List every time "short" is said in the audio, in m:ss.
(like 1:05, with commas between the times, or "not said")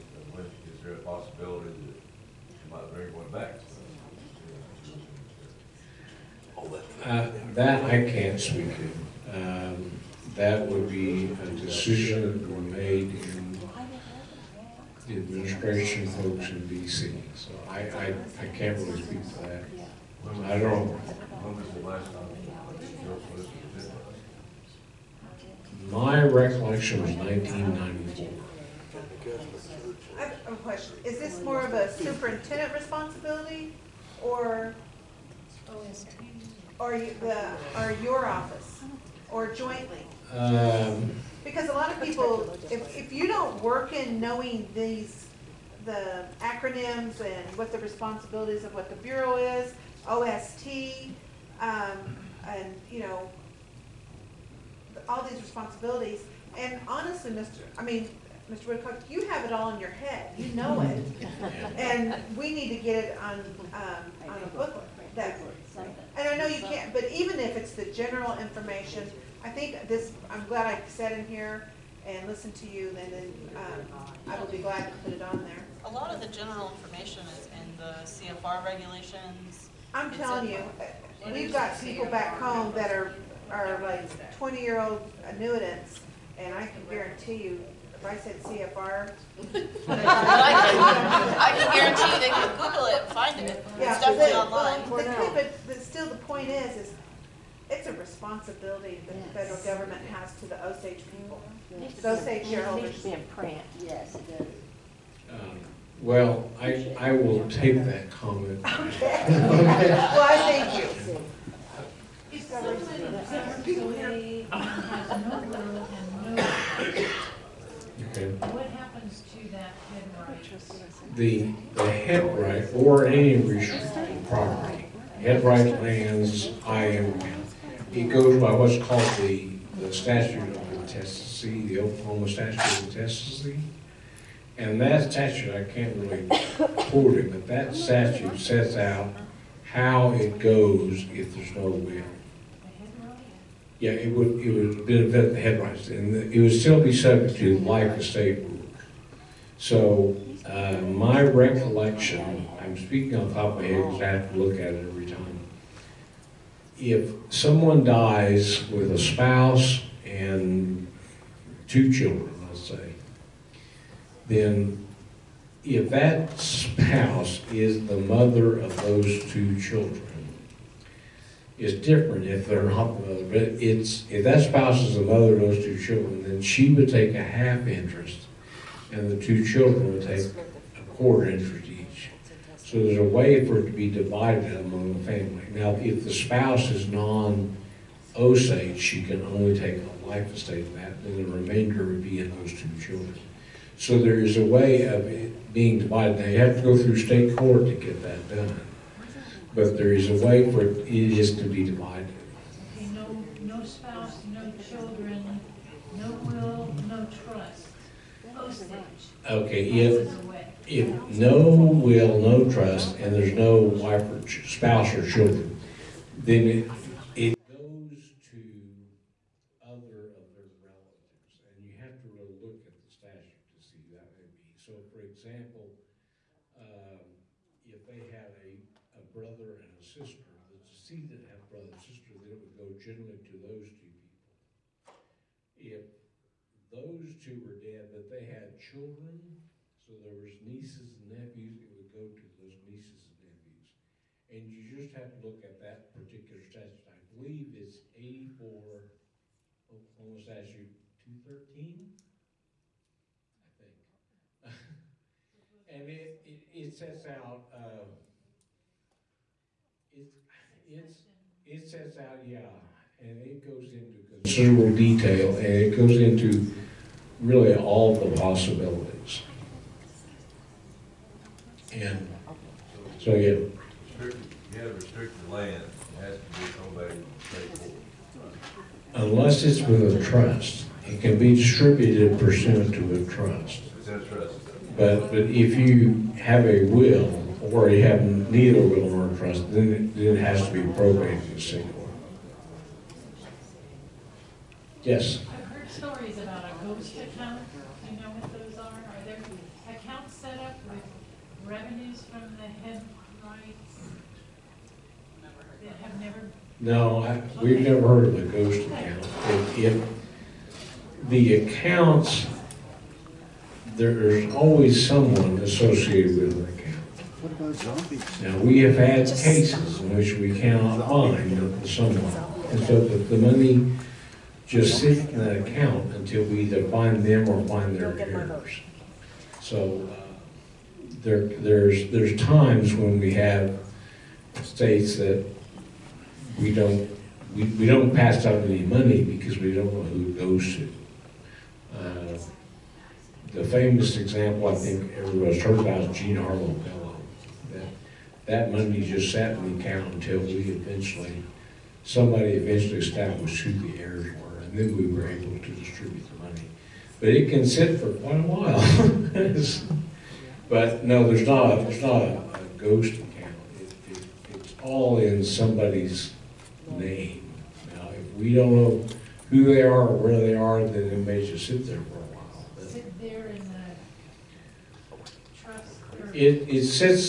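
not said.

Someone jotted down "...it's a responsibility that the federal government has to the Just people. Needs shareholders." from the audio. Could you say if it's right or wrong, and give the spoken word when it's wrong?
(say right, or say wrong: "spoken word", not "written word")
wrong: "Osage", not "Just".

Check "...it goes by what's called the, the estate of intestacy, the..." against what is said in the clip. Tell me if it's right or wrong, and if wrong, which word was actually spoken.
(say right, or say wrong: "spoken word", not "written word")
wrong: "statute", not "estate".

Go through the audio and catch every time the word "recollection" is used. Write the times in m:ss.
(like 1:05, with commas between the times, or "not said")
0:26, 2:31.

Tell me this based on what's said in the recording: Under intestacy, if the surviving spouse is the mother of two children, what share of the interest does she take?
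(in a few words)
Half.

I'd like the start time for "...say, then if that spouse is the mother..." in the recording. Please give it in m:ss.
2:42.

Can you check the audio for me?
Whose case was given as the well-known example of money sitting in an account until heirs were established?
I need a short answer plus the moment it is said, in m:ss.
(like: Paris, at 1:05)
Gene Harlow Bellow, at 5:45.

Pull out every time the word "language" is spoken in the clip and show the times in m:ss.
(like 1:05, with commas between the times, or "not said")
not said.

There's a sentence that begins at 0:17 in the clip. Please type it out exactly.
So I, I, I can't really speak to that.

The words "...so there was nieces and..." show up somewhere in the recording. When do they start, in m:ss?
3:59.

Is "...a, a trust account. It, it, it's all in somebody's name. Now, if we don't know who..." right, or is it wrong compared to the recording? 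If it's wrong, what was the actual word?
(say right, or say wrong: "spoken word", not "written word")
wrong: "ghost", not "trust".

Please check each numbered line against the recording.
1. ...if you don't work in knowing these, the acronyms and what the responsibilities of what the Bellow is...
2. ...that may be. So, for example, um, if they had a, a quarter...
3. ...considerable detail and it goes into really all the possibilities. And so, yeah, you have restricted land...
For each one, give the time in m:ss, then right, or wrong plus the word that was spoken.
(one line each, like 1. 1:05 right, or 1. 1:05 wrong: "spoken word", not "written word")
1. 0:42 wrong: "Bureau", not "Bellow"
2. 3:43 wrong: "brother", not "quarter"
3. 4:24 right.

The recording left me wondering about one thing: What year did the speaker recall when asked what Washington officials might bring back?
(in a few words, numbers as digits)
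1994.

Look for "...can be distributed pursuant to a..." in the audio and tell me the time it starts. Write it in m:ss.
4:40.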